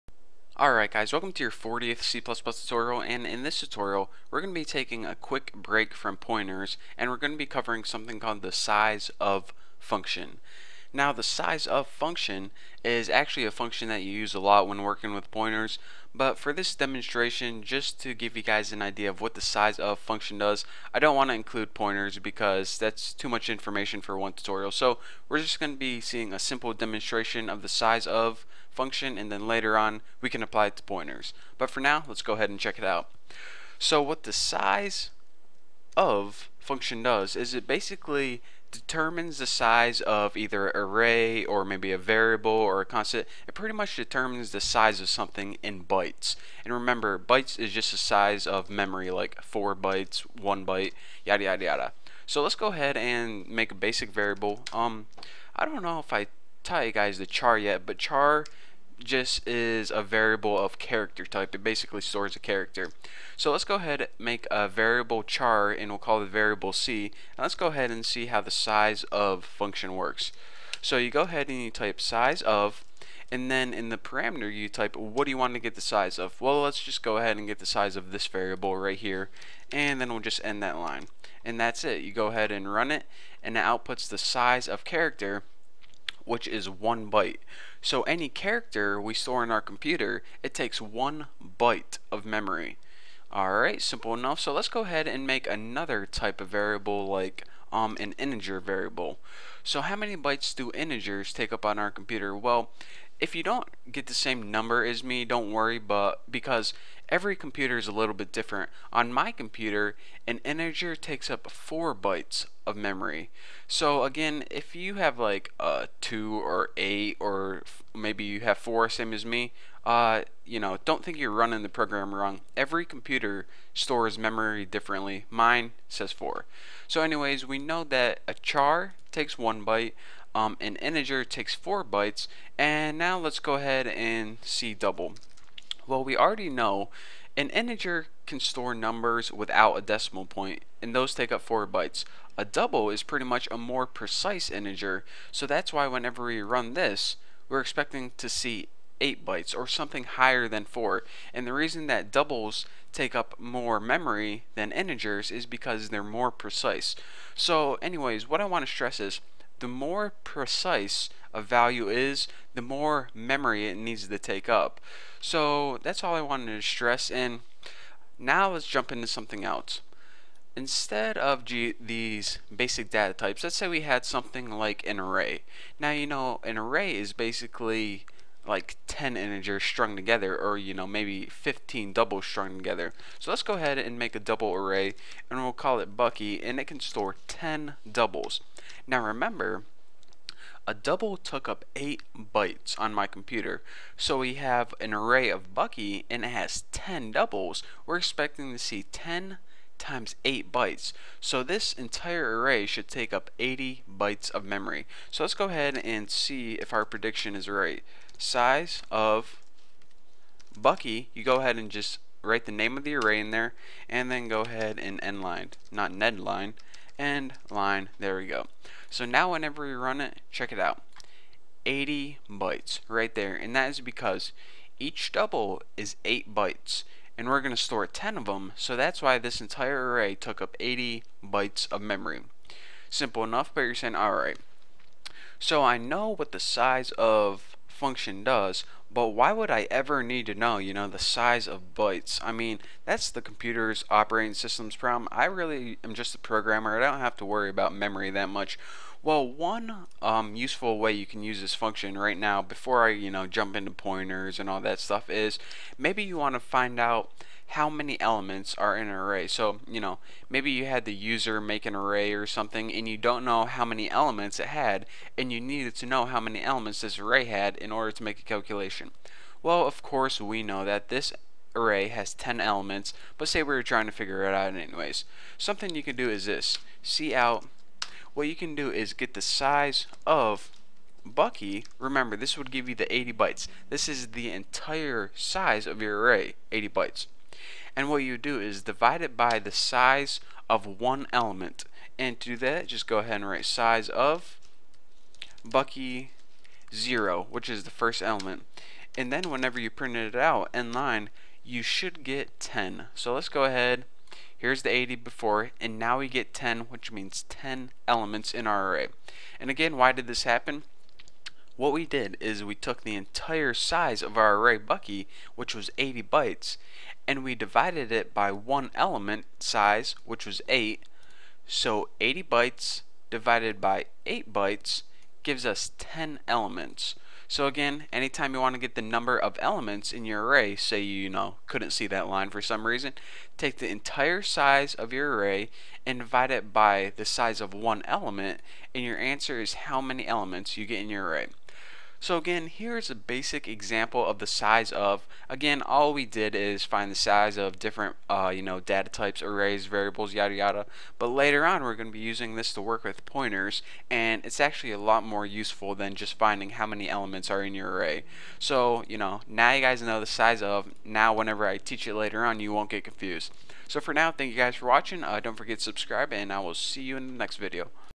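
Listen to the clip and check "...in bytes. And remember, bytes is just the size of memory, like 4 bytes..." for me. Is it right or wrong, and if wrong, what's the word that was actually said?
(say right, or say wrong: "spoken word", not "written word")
right.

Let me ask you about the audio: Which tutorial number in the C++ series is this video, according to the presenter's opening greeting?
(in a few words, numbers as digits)
40th.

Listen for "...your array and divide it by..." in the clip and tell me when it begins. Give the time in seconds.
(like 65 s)
334 s.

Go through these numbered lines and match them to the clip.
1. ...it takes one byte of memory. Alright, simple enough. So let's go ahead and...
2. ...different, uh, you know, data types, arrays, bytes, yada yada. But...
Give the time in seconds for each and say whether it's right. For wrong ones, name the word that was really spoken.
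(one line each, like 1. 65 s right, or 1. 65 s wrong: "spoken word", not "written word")
1. 90 s right
2. 347 s wrong: "variables", not "bytes".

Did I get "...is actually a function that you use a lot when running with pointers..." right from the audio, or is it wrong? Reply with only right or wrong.
wrong.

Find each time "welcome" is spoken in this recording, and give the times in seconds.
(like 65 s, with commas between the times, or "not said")
1 s.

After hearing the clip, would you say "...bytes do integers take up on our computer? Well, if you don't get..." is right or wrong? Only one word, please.
right.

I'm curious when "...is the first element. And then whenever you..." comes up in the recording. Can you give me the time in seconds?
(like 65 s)
297 s.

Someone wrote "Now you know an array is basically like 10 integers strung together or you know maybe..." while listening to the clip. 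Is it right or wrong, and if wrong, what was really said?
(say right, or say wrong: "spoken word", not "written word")
right.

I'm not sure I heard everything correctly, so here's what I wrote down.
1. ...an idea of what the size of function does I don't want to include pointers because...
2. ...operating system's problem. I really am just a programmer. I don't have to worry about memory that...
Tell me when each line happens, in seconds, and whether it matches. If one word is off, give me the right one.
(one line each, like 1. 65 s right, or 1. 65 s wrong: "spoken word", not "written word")
1. 18 s right
2. 243 s right.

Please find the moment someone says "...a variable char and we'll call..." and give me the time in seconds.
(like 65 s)
64 s.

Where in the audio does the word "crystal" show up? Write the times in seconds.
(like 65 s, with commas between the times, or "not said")
not said.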